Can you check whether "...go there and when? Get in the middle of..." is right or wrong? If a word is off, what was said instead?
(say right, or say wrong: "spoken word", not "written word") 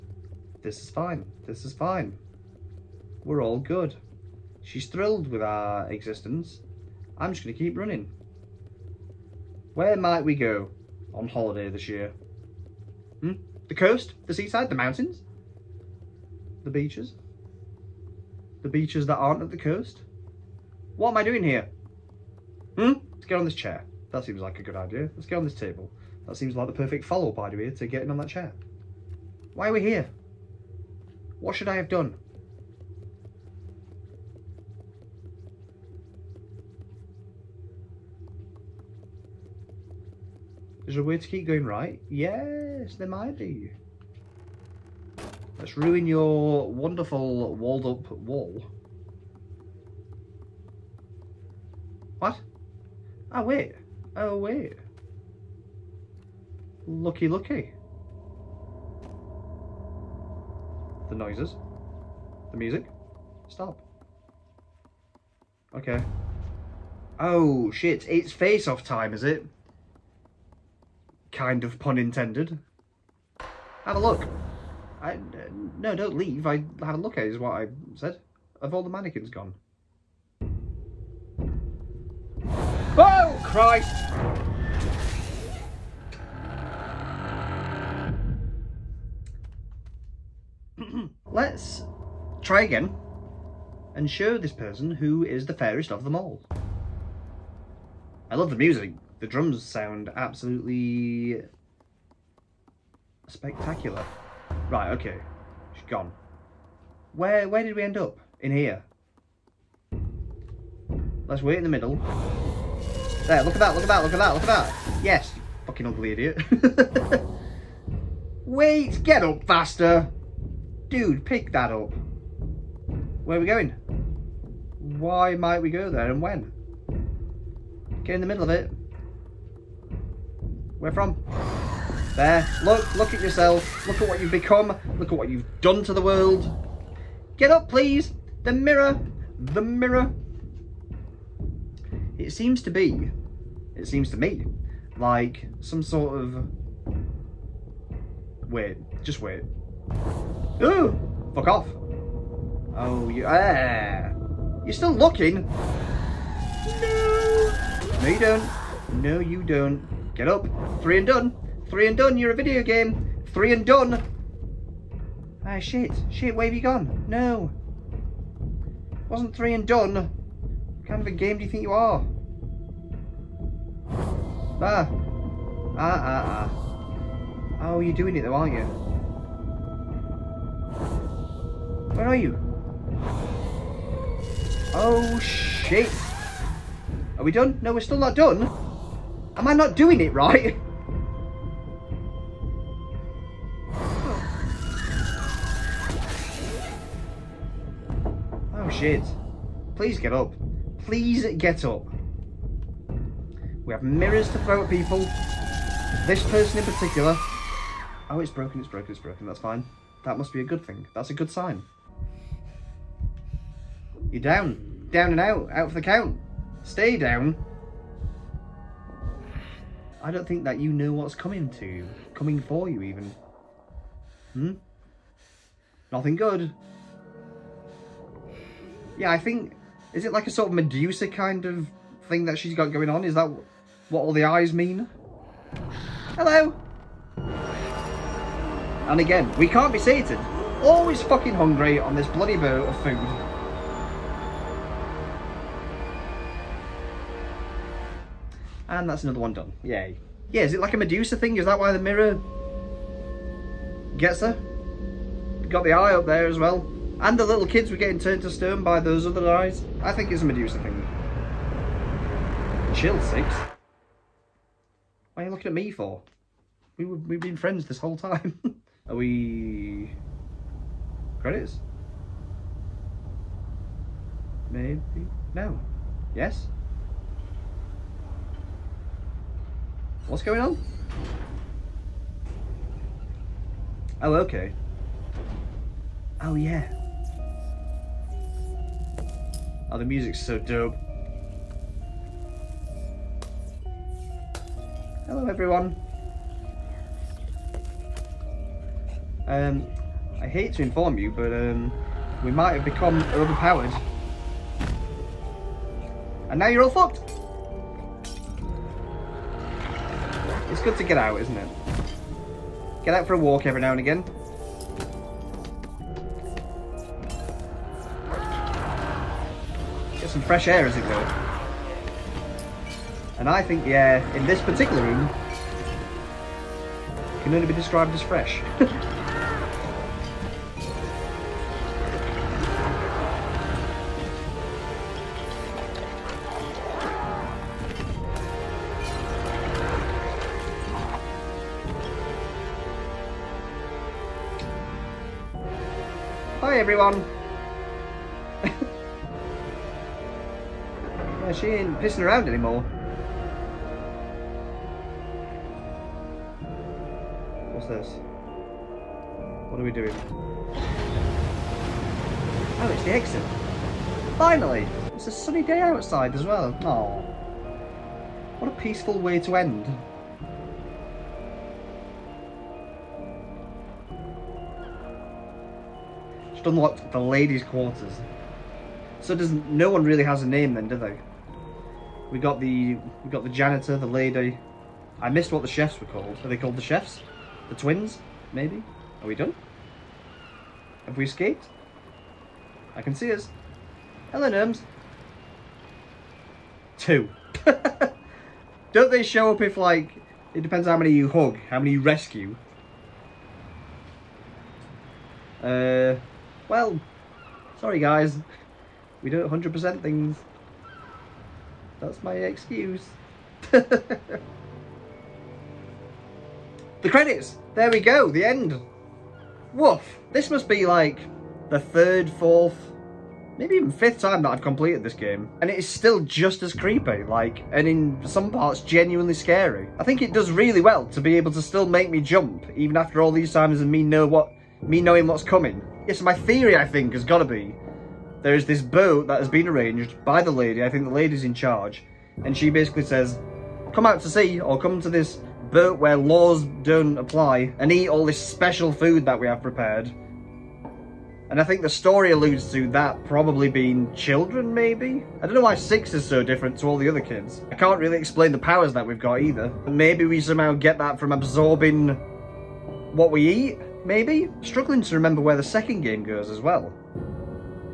right.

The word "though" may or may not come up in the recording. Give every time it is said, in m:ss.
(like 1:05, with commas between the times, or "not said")
2:58.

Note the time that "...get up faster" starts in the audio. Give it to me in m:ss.
1:59.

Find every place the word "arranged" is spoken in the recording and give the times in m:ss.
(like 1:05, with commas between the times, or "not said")
7:19.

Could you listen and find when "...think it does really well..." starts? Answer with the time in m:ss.
7:09.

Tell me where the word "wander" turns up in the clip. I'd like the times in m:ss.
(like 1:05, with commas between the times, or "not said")
not said.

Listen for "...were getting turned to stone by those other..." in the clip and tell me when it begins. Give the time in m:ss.
4:17.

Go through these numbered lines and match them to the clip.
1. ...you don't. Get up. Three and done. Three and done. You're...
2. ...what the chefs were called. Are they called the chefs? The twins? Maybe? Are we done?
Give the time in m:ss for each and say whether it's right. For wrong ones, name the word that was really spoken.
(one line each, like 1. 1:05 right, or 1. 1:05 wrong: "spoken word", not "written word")
1. 2:39 right
2. 6:25 right.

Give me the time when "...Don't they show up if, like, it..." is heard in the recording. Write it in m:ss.
6:38.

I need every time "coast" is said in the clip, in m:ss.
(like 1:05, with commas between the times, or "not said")
0:13, 0:19.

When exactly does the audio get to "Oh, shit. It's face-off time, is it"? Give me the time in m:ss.
1:07.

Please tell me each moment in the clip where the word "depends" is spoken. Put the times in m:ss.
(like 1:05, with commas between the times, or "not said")
6:40.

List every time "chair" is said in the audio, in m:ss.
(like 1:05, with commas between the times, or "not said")
0:23, 0:28.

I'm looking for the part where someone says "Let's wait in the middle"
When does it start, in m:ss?
1:51.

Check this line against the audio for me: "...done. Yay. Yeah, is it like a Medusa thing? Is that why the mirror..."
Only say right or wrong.
right.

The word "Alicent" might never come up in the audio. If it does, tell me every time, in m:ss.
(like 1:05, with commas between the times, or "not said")
not said.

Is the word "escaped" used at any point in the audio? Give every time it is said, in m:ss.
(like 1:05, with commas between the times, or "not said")
6:31.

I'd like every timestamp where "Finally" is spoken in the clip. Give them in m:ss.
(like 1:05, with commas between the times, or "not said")
6:04.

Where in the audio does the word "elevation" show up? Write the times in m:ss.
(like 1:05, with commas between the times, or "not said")
not said.